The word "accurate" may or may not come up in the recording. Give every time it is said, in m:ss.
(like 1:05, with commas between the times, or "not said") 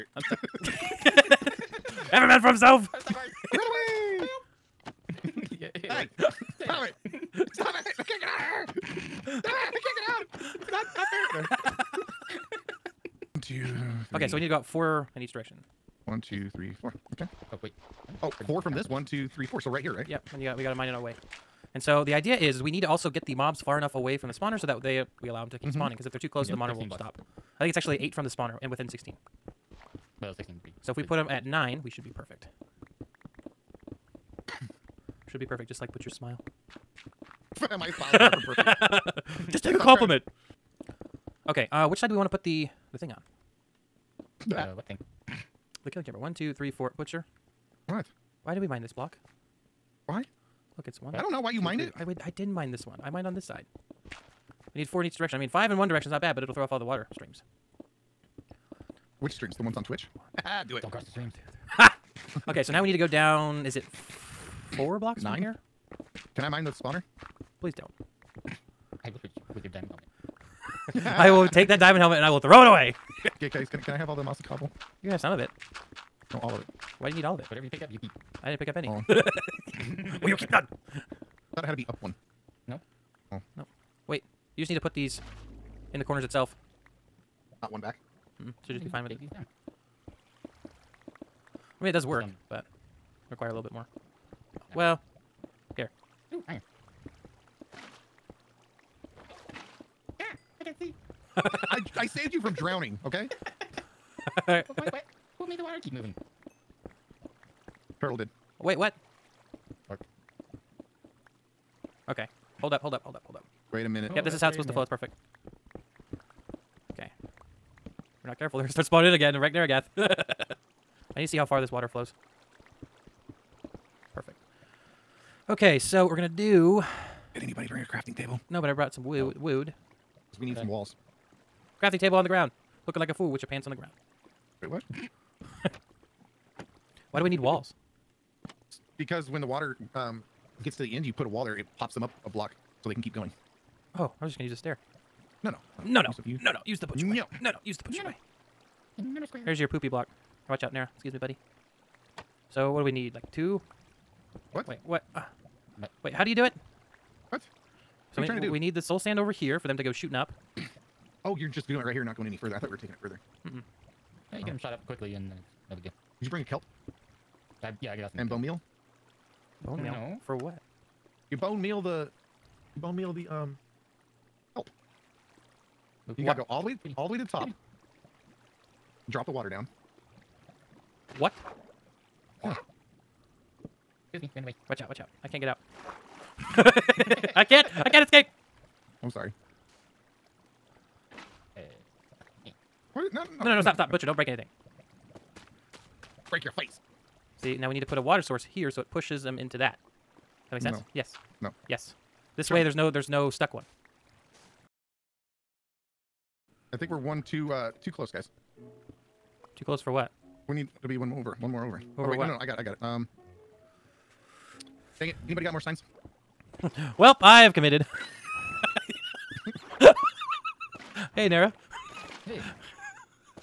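not said.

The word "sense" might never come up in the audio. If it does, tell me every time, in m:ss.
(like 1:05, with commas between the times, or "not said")
3:20.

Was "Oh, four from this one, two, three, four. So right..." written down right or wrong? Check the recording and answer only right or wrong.
right.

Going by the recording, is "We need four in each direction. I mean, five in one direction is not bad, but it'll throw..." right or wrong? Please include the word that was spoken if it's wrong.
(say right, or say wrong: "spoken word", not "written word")
right.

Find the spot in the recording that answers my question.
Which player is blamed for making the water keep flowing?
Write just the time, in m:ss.
1:48.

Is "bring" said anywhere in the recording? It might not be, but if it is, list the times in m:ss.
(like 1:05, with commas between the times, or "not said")
2:07, 2:46.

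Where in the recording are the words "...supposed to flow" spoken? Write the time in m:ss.
1:54.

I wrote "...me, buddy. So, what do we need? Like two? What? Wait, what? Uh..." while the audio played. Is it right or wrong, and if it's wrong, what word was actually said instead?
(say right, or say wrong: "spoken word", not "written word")
right.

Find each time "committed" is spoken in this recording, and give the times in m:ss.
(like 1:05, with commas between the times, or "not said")
3:37.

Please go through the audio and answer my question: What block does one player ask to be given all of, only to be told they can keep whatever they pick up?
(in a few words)
Mossy cobble.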